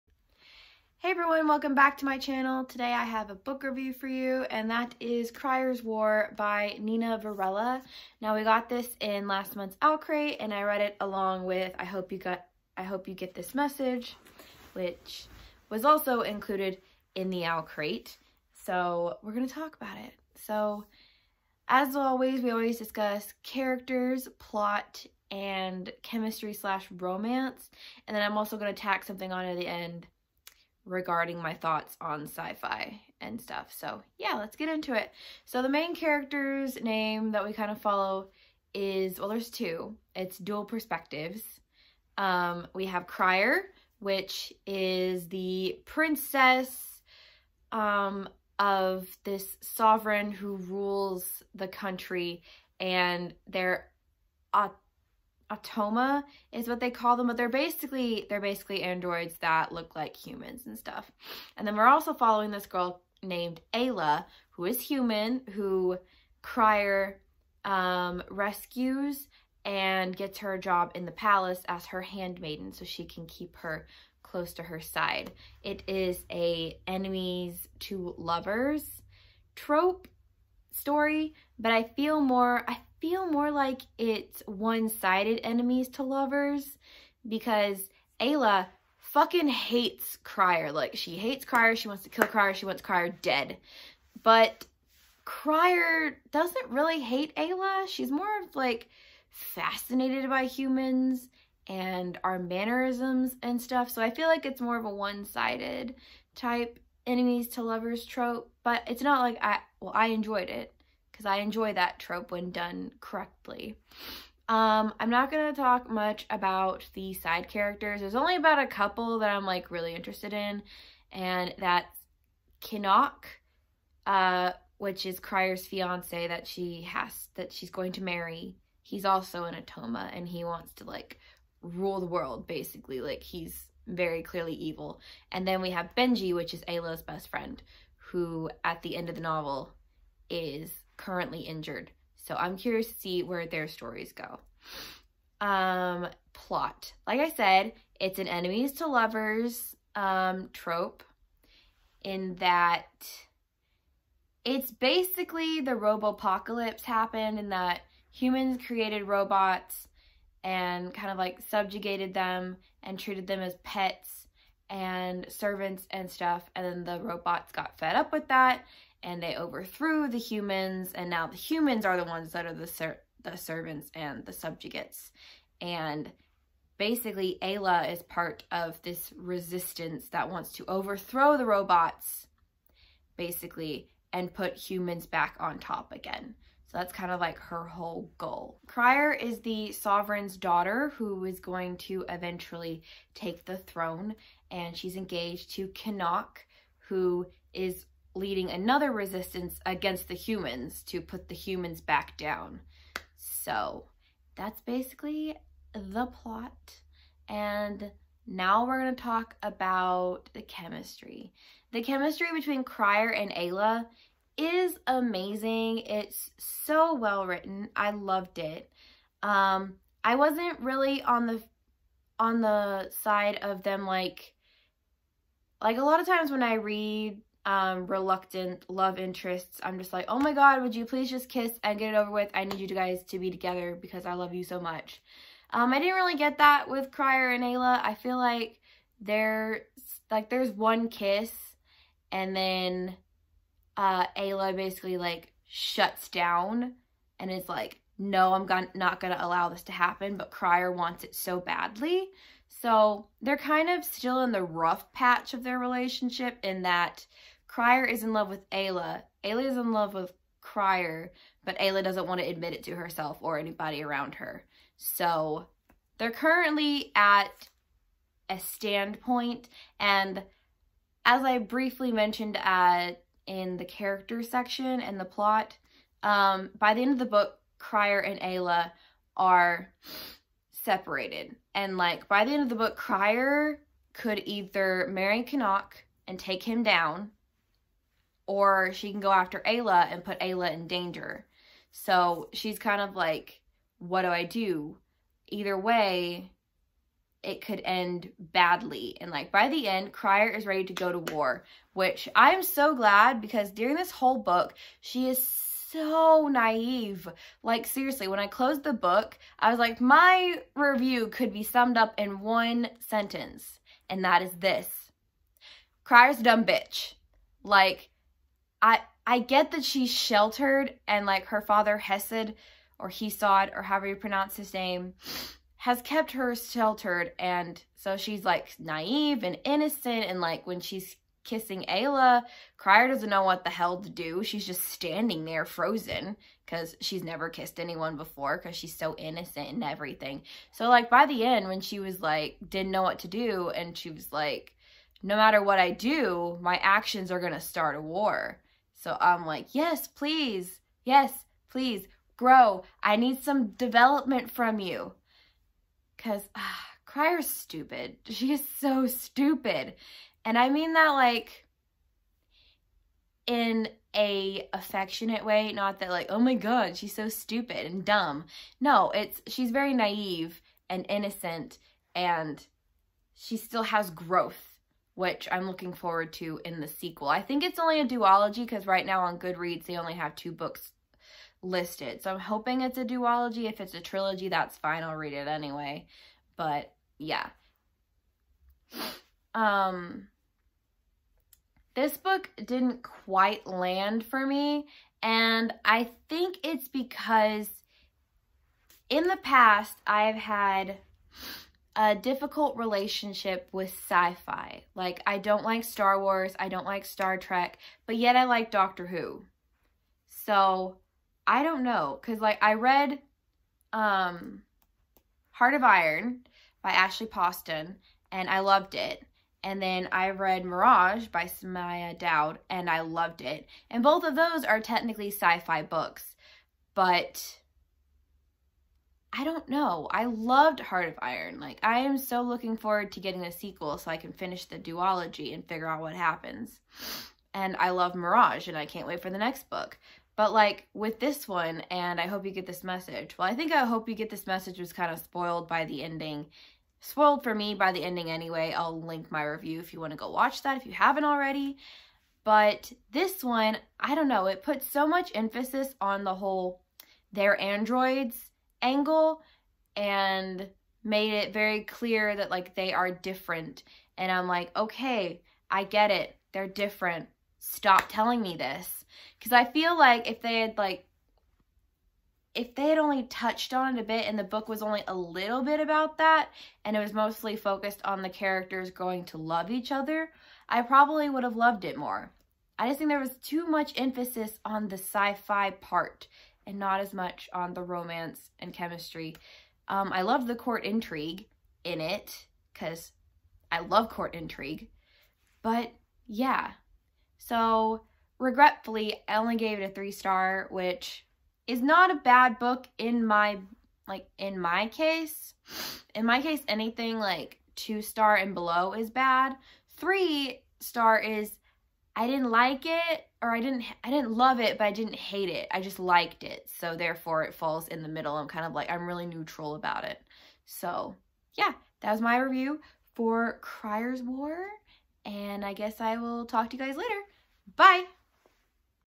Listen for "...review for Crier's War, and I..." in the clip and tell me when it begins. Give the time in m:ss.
8:42.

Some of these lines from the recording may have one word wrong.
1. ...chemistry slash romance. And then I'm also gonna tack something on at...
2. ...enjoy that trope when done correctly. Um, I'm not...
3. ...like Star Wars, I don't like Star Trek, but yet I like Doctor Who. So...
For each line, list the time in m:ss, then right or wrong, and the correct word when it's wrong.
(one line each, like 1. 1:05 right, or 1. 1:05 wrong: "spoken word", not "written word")
1. 0:26 right
2. 1:51 right
3. 6:45 right.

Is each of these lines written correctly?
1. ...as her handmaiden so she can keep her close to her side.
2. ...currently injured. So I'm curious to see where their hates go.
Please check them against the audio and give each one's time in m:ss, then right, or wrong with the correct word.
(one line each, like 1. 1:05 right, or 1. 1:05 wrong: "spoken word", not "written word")
1. 1:11 right
2. 2:21 wrong: "stories", not "hates".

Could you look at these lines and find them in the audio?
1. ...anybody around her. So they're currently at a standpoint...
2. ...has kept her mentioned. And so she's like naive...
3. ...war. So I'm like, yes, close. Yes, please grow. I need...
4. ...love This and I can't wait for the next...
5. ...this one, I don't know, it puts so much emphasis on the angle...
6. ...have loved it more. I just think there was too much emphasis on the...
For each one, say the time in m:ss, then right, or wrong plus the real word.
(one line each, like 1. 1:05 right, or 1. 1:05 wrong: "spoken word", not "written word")
1. 4:23 right
2. 5:25 wrong: "sheltered", not "mentioned"
3. 5:47 wrong: "please", not "close"
4. 7:17 wrong: "Mirage", not "This"
5. 7:32 wrong: "whole", not "angle"
6. 8:01 right.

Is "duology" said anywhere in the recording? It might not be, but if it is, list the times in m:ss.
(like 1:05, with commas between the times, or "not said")
6:17, 6:22, 7:14.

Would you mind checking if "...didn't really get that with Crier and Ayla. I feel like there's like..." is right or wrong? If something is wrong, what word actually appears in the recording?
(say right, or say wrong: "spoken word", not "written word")
right.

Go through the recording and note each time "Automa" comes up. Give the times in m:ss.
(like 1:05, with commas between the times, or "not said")
0:55, 2:09.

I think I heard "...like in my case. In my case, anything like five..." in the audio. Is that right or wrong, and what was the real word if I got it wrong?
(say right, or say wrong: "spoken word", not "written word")
wrong: "two", not "five".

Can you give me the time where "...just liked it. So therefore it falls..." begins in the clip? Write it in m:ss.
8:35.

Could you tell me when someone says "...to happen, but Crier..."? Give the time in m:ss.
4:09.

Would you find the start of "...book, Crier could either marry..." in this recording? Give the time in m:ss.
4:42.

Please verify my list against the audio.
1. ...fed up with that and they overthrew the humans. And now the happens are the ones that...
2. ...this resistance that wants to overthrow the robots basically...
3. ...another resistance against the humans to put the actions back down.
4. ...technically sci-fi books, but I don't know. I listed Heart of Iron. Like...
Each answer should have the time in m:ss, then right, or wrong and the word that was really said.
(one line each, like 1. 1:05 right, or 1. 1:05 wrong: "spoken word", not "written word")
1. 2:47 wrong: "humans", not "happens"
2. 2:58 right
3. 3:18 wrong: "humans", not "actions"
4. 7:04 wrong: "loved", not "listed".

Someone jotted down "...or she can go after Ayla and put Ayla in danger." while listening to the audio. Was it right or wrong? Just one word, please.
right.